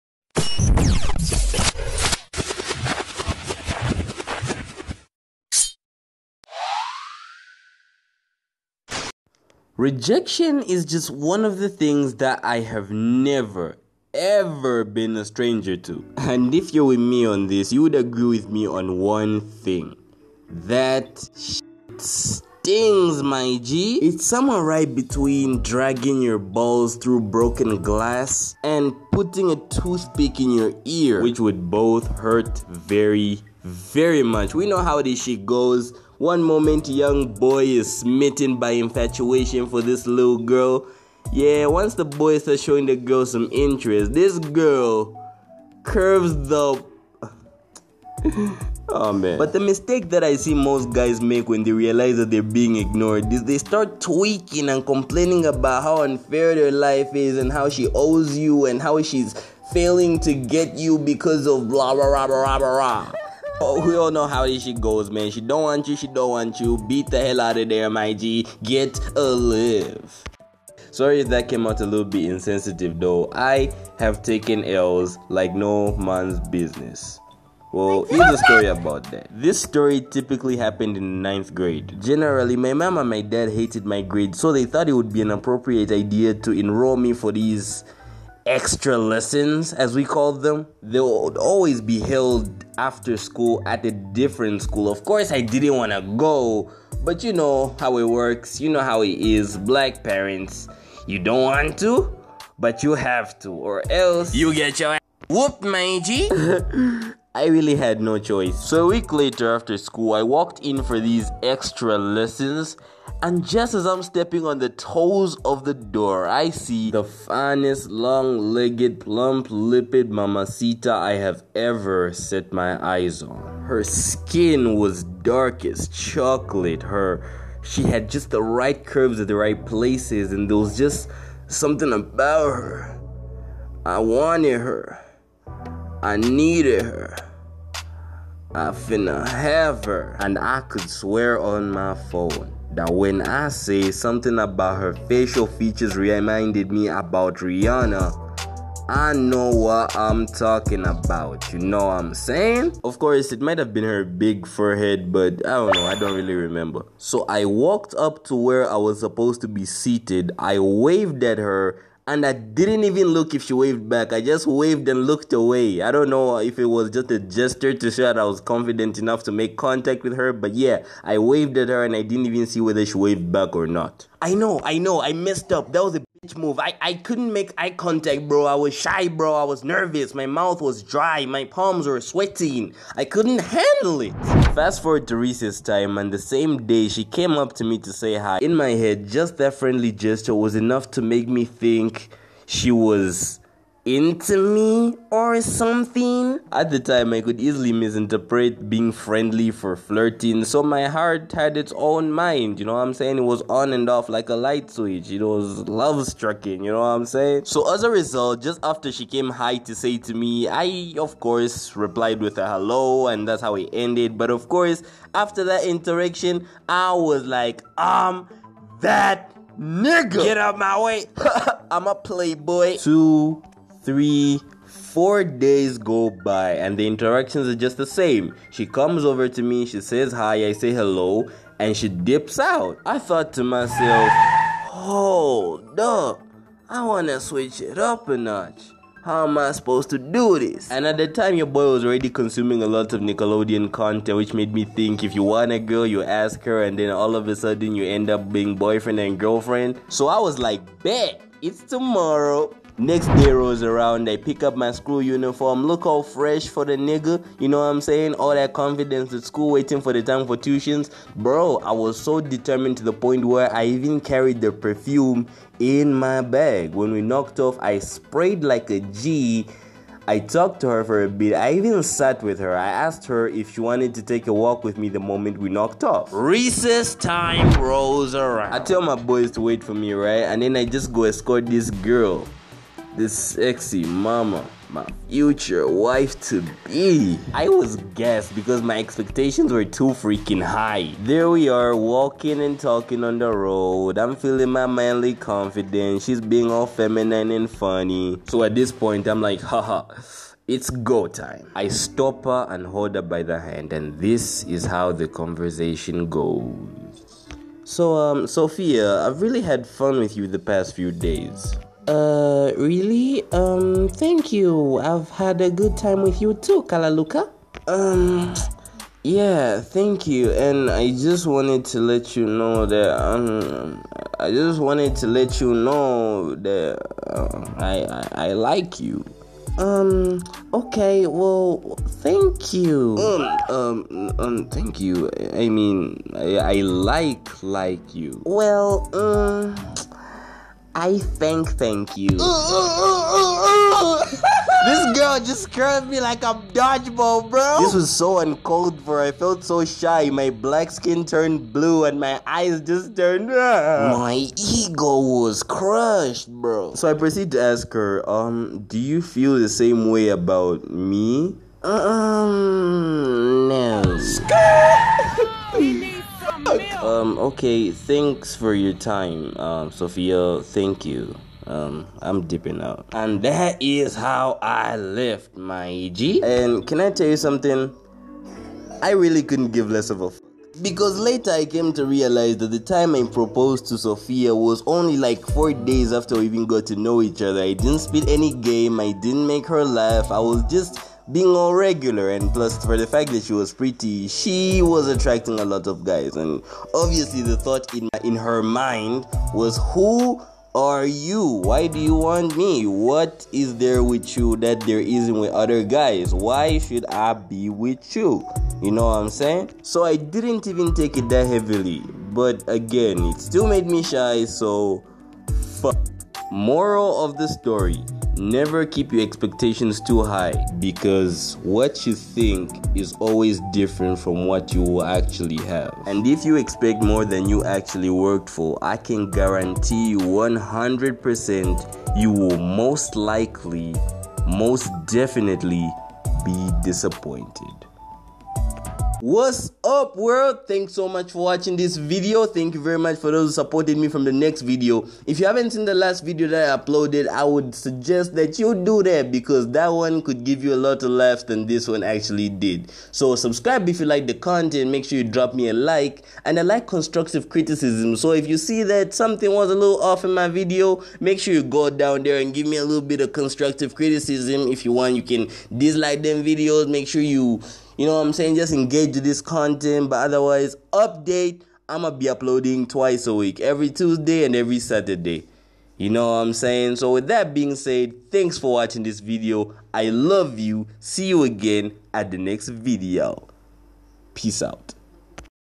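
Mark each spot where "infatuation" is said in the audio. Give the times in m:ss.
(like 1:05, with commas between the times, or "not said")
0:38.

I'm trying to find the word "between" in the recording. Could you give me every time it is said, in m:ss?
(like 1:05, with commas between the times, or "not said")
0:24.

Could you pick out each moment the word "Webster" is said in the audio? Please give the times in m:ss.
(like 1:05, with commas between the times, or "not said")
not said.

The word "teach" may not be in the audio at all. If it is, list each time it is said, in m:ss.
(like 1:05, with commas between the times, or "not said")
not said.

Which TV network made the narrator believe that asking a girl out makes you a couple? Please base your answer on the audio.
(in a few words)
Nickelodeon.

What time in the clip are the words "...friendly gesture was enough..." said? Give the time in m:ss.
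3:09.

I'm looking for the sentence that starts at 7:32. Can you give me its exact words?
So subscribe if you like the content.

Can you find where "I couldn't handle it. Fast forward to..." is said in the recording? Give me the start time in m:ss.
3:02.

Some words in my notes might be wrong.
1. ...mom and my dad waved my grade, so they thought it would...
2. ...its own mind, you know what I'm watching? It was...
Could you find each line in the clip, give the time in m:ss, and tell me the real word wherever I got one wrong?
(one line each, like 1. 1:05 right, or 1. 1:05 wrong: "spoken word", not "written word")
1. 1:22 wrong: "hated", not "waved"
2. 3:21 wrong: "saying", not "watching".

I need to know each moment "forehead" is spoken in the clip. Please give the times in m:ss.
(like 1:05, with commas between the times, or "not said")
2:34.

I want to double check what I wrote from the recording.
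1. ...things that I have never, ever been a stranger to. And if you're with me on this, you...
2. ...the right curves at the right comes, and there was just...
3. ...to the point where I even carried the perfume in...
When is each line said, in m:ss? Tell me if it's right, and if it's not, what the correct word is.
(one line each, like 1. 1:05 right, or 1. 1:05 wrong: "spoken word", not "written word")
1. 0:11 right
2. 2:08 wrong: "places", not "comes"
3. 4:22 right.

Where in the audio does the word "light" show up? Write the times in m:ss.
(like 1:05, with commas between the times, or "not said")
3:24.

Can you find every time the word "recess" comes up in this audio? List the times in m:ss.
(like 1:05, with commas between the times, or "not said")
3:05, 4:36.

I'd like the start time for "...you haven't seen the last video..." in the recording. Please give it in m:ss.
7:25.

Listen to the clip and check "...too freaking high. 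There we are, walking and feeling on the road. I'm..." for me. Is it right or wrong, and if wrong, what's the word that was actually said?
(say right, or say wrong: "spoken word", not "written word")
wrong: "talking", not "feeling".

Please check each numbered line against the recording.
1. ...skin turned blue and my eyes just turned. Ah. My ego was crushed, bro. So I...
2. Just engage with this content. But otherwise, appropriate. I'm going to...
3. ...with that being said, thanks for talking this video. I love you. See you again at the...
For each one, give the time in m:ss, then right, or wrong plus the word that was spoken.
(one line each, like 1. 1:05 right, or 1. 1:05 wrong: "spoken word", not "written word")
1. 5:50 right
2. 7:48 wrong: "update", not "appropriate"
3. 7:56 wrong: "watching", not "talking".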